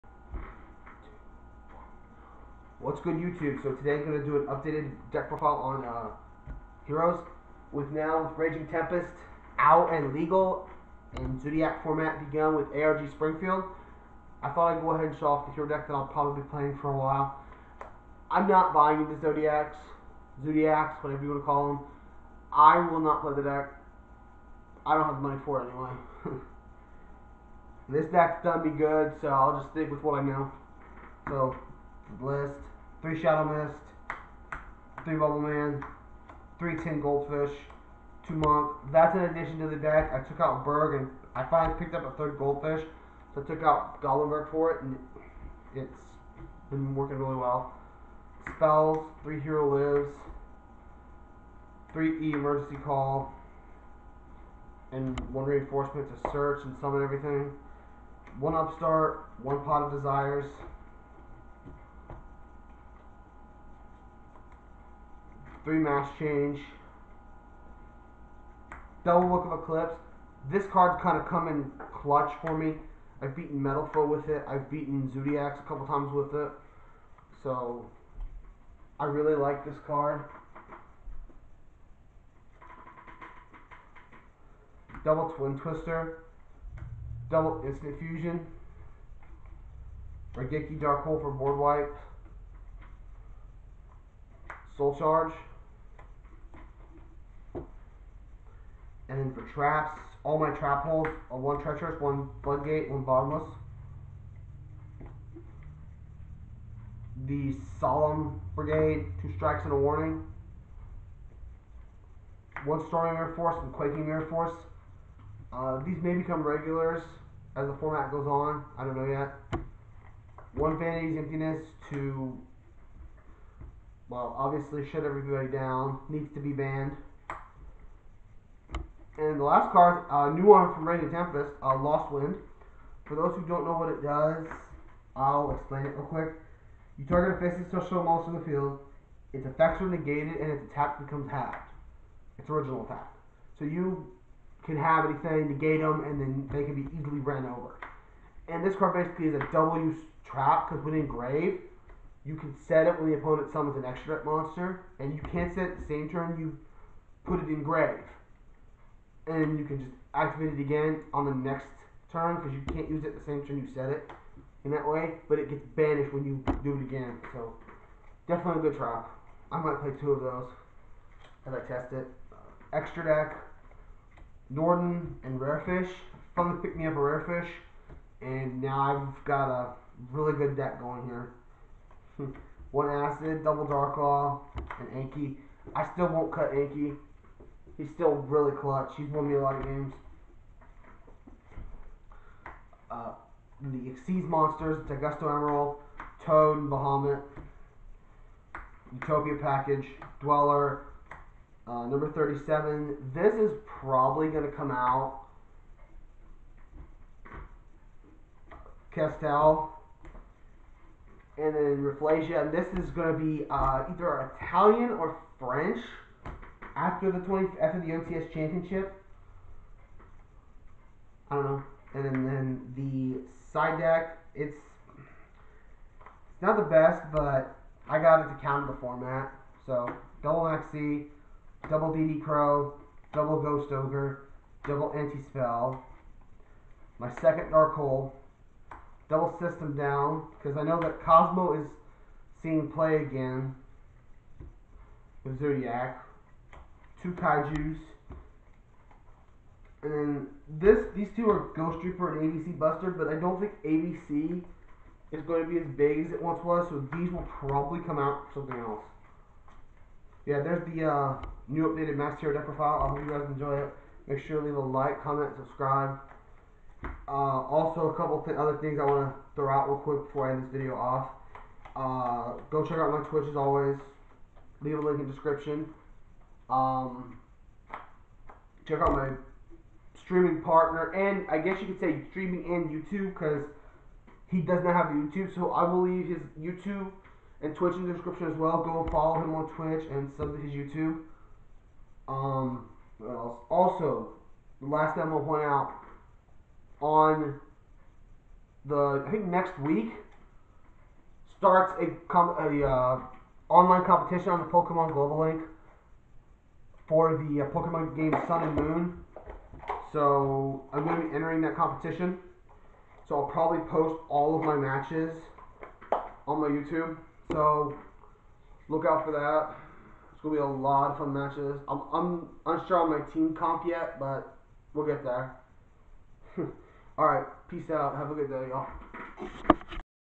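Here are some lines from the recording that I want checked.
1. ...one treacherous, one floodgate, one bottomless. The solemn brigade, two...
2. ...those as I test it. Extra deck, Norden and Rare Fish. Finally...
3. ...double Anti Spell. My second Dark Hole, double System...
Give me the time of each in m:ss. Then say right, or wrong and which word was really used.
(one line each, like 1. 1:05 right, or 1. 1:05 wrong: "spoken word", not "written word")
1. 1:41 right
2. 2:50 right
3. 3:54 right.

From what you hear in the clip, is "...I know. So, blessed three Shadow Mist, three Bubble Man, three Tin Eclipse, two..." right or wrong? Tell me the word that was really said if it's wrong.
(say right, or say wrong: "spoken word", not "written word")
wrong: "Goldfish", not "Eclipse".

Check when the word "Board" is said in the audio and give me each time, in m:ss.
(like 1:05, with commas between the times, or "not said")
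1:31.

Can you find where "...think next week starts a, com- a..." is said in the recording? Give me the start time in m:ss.
4:59.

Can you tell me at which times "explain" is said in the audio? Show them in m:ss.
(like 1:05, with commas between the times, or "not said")
2:15.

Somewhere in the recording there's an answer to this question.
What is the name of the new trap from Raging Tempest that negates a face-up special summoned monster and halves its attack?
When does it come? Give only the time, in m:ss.
2:11.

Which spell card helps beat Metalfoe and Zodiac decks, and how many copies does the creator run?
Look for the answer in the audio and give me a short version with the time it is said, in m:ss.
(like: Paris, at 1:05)
2 Book of Eclipse, at 1:09.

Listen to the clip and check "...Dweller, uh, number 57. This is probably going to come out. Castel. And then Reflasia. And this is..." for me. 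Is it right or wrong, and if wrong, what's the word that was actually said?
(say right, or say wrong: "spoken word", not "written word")
wrong: "37", not "57".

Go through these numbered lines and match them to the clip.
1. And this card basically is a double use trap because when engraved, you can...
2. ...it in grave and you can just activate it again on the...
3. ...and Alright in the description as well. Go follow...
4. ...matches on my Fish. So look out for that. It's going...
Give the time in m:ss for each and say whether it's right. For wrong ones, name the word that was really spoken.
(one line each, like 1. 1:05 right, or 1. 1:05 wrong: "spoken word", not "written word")
1. 2:28 right
2. 2:37 right
3. 4:47 wrong: "Twitch", not "Alright"
4. 5:14 wrong: "YouTube", not "Fish".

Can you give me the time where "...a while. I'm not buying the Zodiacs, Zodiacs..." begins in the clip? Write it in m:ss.
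0:16.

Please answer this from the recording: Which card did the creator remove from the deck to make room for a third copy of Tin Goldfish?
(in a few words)
Goblindbergh.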